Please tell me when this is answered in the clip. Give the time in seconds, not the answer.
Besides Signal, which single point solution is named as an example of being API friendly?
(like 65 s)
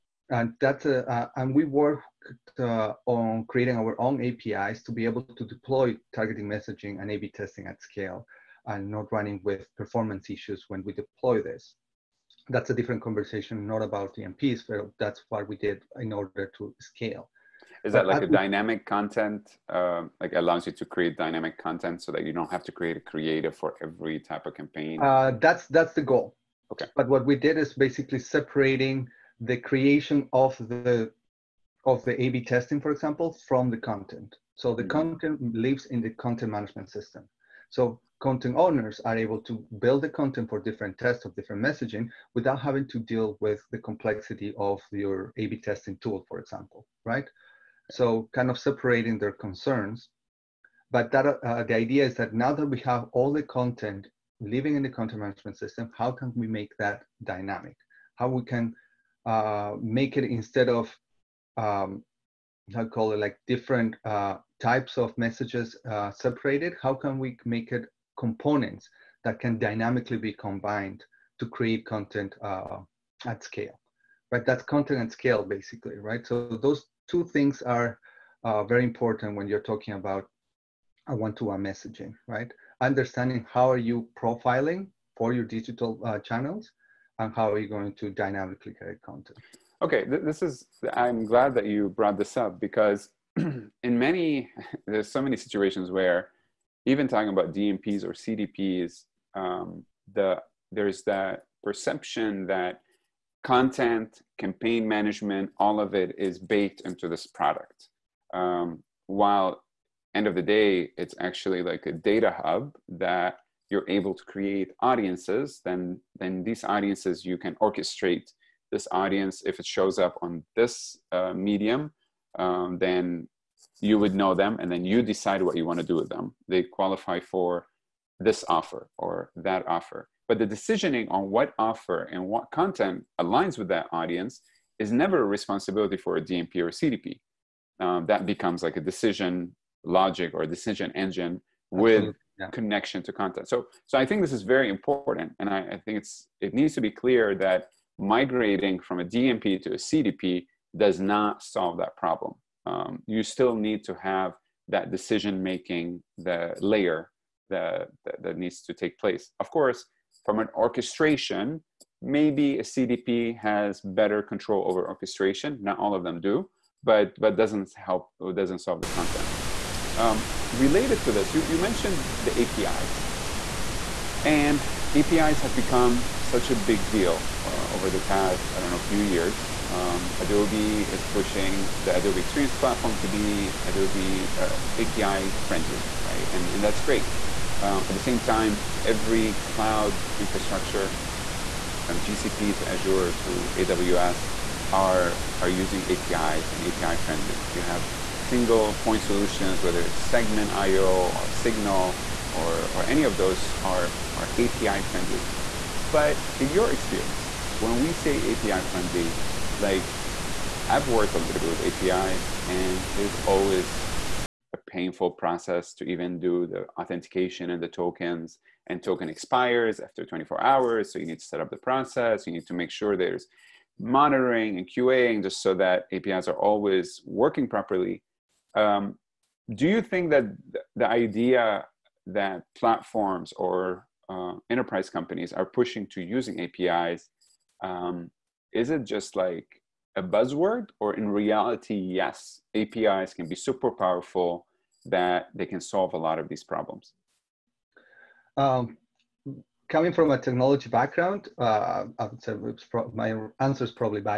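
199 s.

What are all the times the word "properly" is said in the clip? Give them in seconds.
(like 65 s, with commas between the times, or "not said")
227 s.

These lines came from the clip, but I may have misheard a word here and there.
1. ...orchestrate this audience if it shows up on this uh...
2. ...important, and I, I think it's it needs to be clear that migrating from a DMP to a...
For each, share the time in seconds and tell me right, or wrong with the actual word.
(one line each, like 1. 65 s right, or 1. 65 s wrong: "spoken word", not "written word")
1. 117 s right
2. 144 s right.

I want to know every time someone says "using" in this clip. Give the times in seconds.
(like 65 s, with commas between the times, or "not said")
195 s, 236 s.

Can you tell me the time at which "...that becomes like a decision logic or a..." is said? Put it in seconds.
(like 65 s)
138 s.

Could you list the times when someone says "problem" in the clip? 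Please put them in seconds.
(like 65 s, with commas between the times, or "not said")
151 s, 246 s.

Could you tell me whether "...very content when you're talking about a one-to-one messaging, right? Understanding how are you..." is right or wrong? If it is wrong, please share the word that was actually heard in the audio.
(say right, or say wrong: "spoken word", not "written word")
wrong: "important", not "content".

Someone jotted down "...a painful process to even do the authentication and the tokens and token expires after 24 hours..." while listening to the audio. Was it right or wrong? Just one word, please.
right.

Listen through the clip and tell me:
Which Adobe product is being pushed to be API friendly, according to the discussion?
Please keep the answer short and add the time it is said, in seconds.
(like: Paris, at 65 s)
Adobe Experience Platform, at 181 s.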